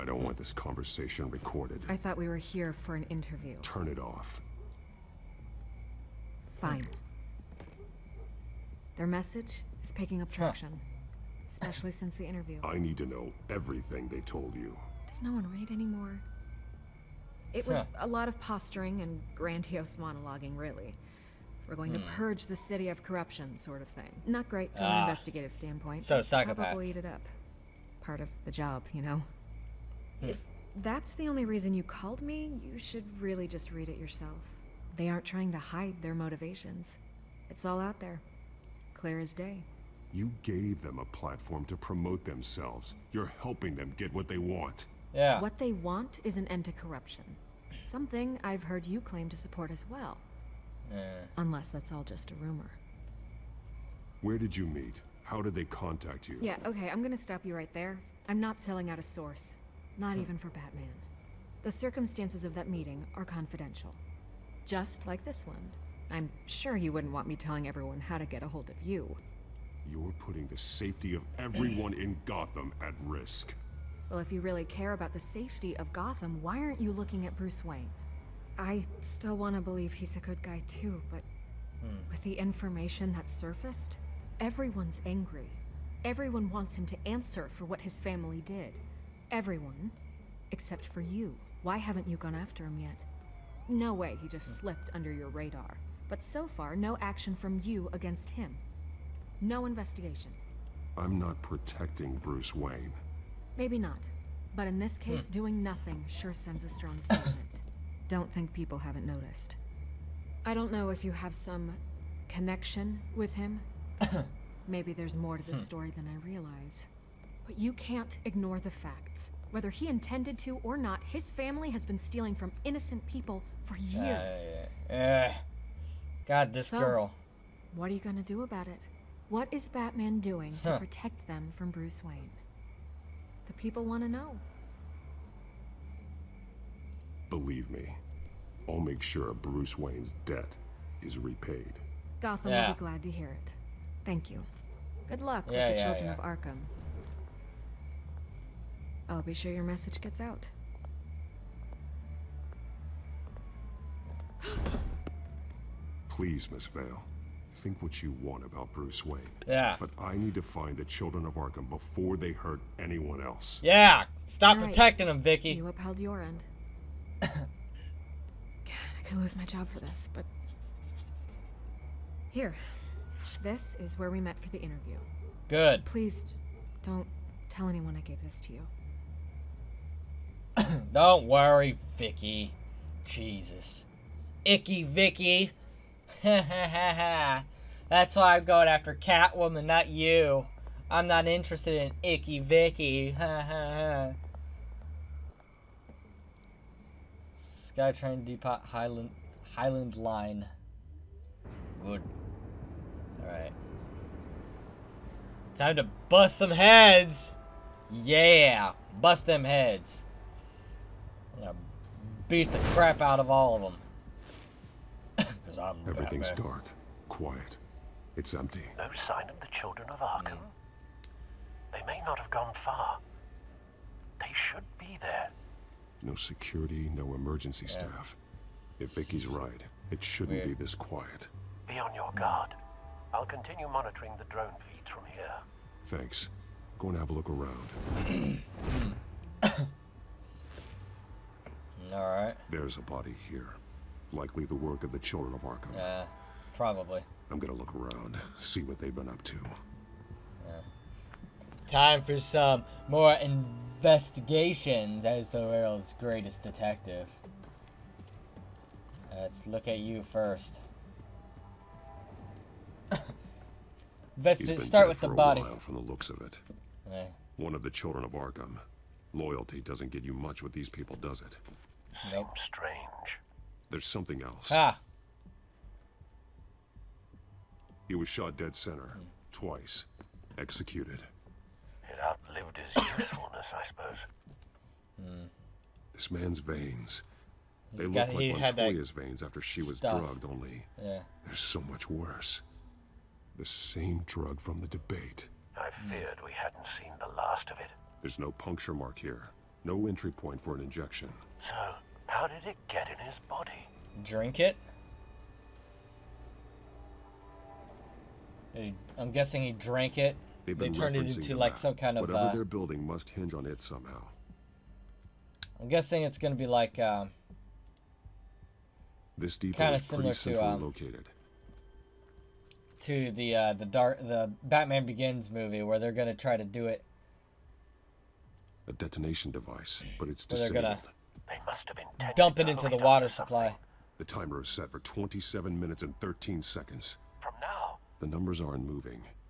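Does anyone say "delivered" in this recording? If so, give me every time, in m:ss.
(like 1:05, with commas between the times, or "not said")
not said.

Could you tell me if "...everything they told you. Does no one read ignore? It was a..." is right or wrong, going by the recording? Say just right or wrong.
wrong.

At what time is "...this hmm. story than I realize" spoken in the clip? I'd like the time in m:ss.
1:55.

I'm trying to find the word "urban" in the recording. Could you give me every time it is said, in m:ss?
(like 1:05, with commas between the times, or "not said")
not said.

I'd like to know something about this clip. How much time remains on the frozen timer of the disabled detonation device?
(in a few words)
27 minutes 13 seconds.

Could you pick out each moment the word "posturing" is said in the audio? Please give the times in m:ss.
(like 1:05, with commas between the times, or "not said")
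0:18.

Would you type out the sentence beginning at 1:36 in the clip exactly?
But so far, no action from you against him.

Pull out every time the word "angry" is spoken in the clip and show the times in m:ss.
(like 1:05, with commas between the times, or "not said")
1:25.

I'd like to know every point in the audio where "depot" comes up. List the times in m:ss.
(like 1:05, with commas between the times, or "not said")
3:18, 5:19.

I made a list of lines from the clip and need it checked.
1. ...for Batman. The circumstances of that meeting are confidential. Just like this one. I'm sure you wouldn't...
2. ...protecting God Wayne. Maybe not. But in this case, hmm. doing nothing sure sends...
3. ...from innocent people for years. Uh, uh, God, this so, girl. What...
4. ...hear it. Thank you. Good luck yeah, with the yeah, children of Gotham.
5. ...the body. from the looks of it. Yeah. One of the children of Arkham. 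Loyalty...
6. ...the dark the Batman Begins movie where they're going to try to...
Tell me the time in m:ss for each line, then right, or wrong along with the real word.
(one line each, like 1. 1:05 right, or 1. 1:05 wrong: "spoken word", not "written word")
1. 1:00 right
2. 1:41 wrong: "Bruce", not "God"
3. 2:02 right
4. 2:23 wrong: "Arkham", not "Gotham"
5. 4:25 right
6. 5:23 right.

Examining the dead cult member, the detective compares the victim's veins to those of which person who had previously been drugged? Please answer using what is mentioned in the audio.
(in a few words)
Montoya.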